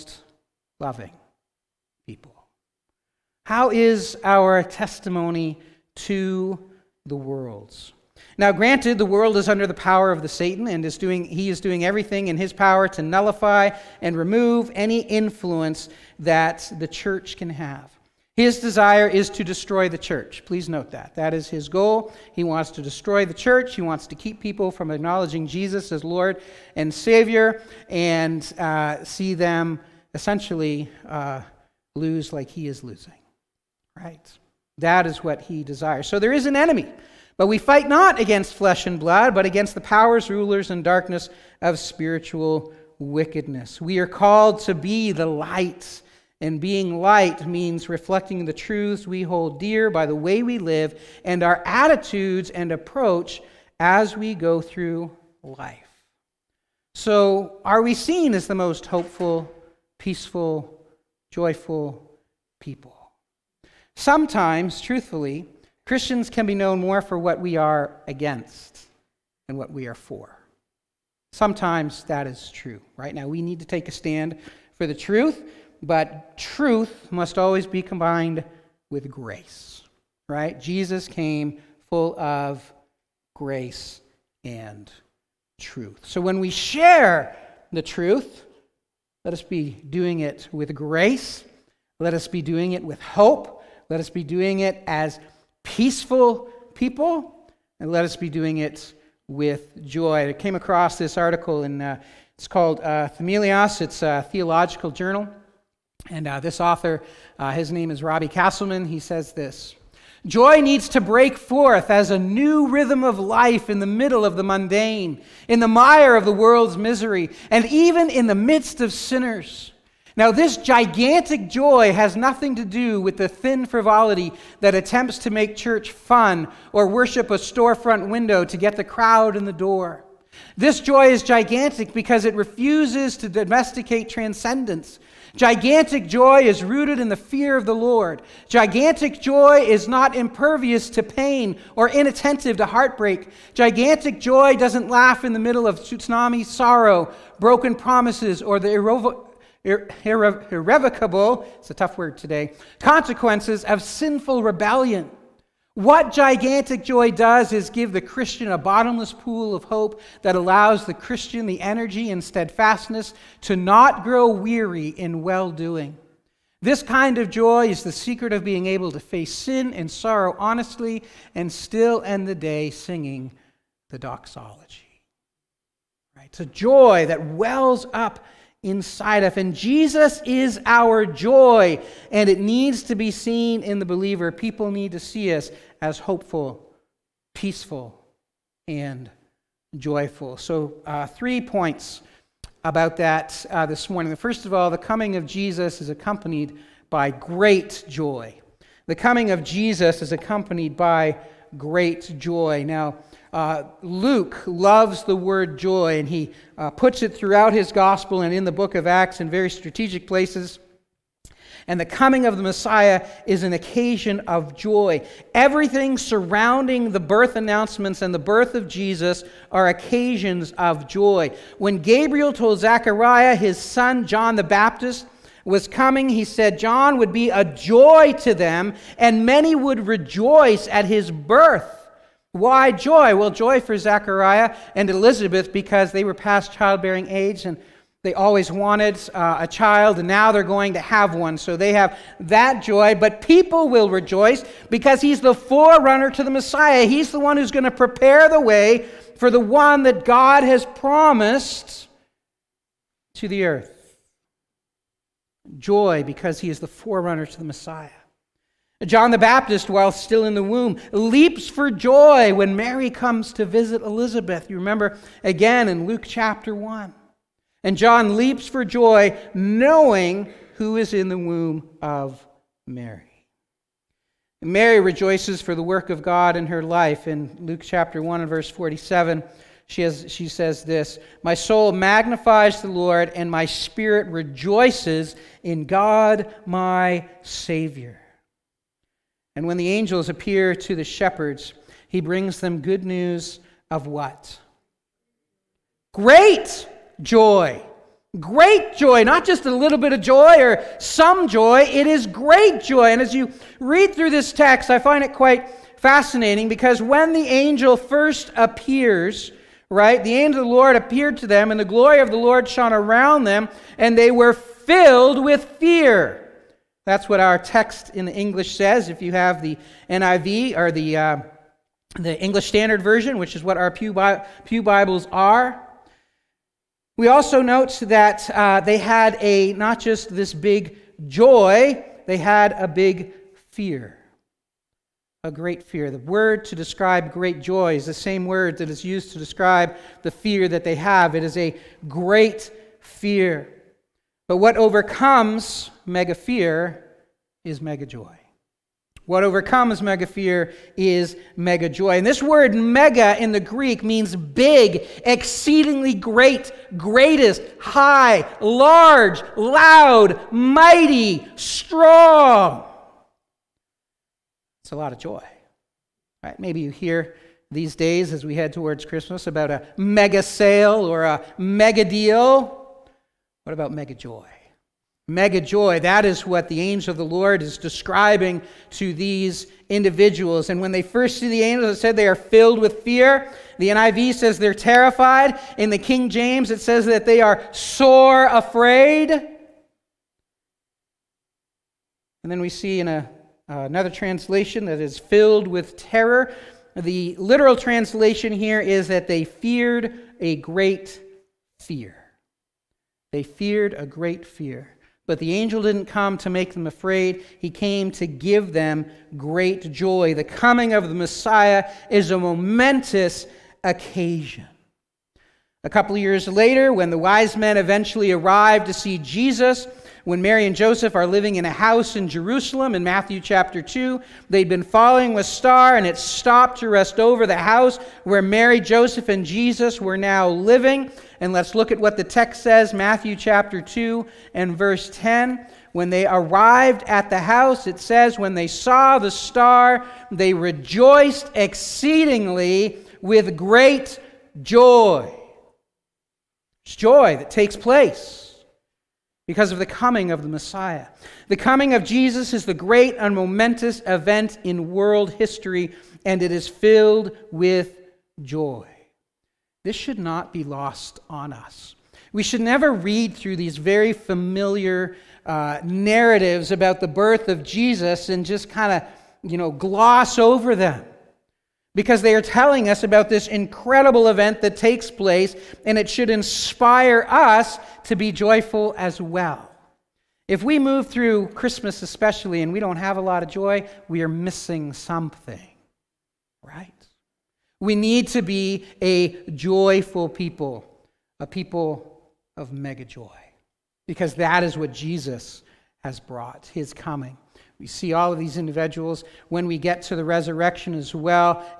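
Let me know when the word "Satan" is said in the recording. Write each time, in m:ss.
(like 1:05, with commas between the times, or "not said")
0:10.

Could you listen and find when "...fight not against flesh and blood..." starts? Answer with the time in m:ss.
0:37.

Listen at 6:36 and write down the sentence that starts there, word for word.
The literal translation here is that they feared a great fear.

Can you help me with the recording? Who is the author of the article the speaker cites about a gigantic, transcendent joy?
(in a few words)
Robbie Castleman.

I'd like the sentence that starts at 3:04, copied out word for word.
People need to see us as hopeful, peaceful, and joyful.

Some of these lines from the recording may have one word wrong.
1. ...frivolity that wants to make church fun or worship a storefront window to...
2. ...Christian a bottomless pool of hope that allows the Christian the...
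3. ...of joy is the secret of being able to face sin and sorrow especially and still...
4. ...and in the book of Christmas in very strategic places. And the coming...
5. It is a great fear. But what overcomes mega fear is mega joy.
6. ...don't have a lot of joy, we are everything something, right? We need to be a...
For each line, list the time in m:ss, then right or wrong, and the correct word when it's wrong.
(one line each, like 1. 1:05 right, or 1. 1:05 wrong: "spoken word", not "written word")
1. 2:03 wrong: "attempts", not "wants"
2. 2:38 right
3. 2:47 wrong: "honestly", not "especially"
4. 3:28 wrong: "Acts", not "Christmas"
5. 5:41 right
6. 8:02 wrong: "missing", not "everything".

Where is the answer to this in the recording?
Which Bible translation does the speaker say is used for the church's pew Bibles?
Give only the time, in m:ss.
5:22.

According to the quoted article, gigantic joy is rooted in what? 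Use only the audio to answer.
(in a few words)
The fear of the Lord.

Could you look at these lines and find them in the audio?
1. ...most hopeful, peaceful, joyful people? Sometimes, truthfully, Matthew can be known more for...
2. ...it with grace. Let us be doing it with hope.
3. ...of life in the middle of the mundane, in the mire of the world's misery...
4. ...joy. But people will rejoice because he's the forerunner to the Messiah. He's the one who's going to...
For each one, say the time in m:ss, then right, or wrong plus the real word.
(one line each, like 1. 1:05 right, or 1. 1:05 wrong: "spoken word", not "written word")
1. 0:58 wrong: "Christians", not "Matthew"
2. 1:30 right
3. 1:53 right
4. 4:02 right.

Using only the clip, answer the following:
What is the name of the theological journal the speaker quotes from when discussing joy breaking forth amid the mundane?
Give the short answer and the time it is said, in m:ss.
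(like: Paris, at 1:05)
Themelios, at 1:43.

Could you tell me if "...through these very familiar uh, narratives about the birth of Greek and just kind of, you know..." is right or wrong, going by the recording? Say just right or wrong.
wrong.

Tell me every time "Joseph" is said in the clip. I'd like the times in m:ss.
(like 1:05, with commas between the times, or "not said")
7:00, 7:08.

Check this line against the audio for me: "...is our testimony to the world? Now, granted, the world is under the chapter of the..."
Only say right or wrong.
wrong.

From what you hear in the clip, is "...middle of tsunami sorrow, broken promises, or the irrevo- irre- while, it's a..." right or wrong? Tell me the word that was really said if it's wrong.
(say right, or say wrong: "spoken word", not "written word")
wrong: "irrevocable", not "while".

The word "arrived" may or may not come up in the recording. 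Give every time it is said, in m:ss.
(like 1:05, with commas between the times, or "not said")
6:58, 7:16.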